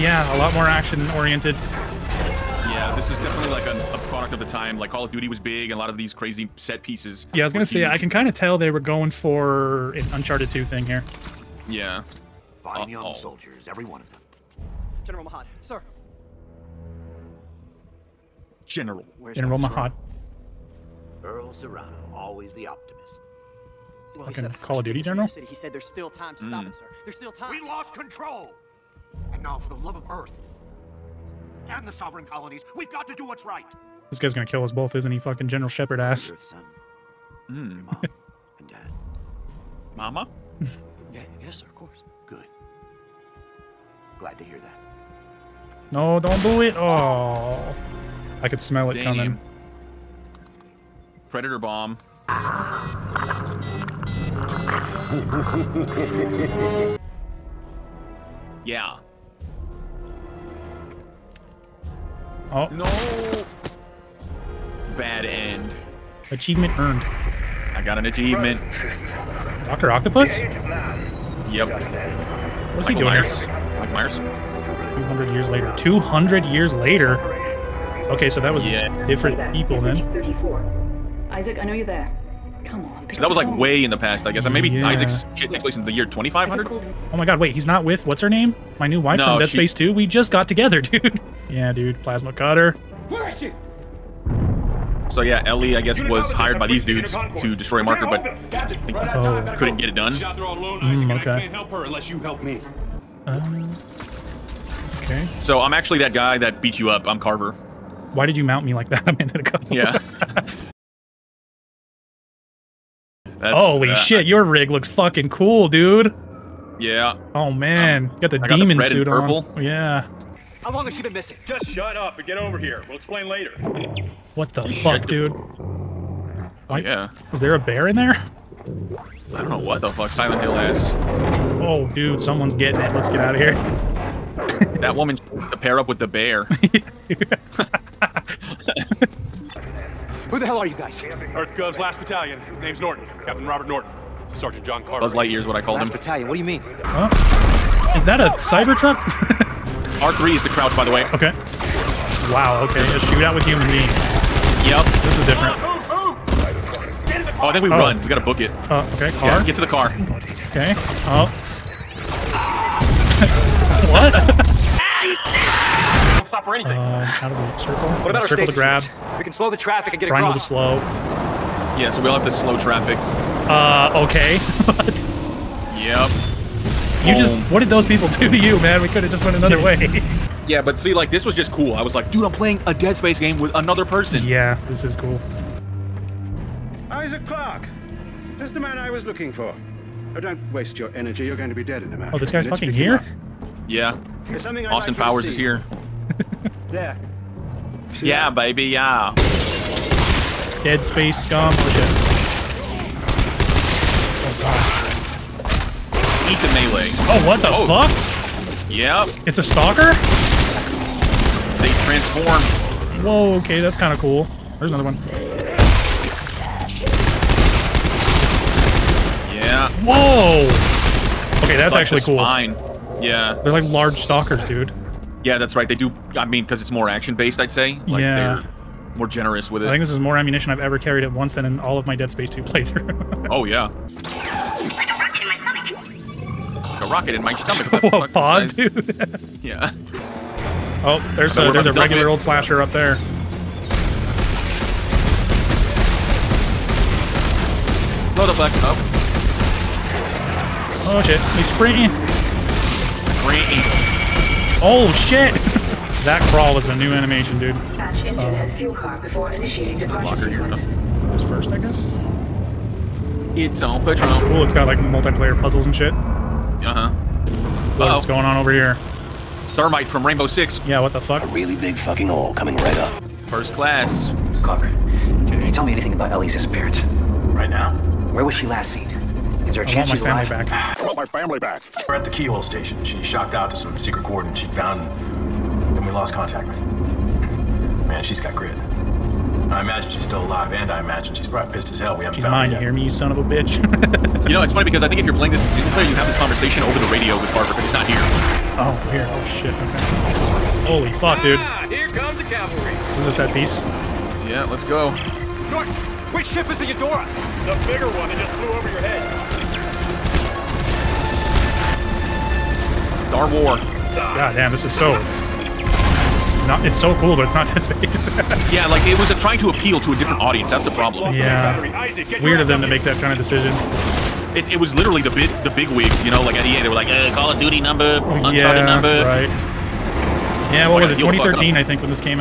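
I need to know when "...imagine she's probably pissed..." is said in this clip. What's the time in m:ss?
4:50.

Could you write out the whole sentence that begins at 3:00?
yeah, but see, like, this was just cool.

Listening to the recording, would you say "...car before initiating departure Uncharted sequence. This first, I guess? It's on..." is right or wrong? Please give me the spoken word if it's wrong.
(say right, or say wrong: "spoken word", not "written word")
wrong: "Locker", not "Uncharted".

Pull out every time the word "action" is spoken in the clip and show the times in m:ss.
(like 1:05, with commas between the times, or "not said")
0:00, 3:46.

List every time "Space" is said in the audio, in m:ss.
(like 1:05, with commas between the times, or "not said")
1:29, 3:02, 3:20, 3:52, 5:17.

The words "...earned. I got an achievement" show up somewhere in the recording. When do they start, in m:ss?
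1:06.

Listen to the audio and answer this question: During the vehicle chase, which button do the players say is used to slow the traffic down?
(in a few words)
Triangle.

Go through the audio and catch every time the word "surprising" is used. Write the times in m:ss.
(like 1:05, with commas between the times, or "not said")
not said.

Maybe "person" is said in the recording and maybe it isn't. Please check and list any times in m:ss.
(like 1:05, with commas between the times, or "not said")
3:03.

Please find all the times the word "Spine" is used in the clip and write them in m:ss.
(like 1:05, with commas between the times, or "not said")
3:42.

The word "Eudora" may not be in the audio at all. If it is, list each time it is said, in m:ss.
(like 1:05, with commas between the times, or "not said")
5:06.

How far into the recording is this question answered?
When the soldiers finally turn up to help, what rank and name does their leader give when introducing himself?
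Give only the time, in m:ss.
2:23.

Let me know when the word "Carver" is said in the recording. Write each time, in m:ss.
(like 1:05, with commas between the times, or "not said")
1:47, 2:24, 4:34, 4:57.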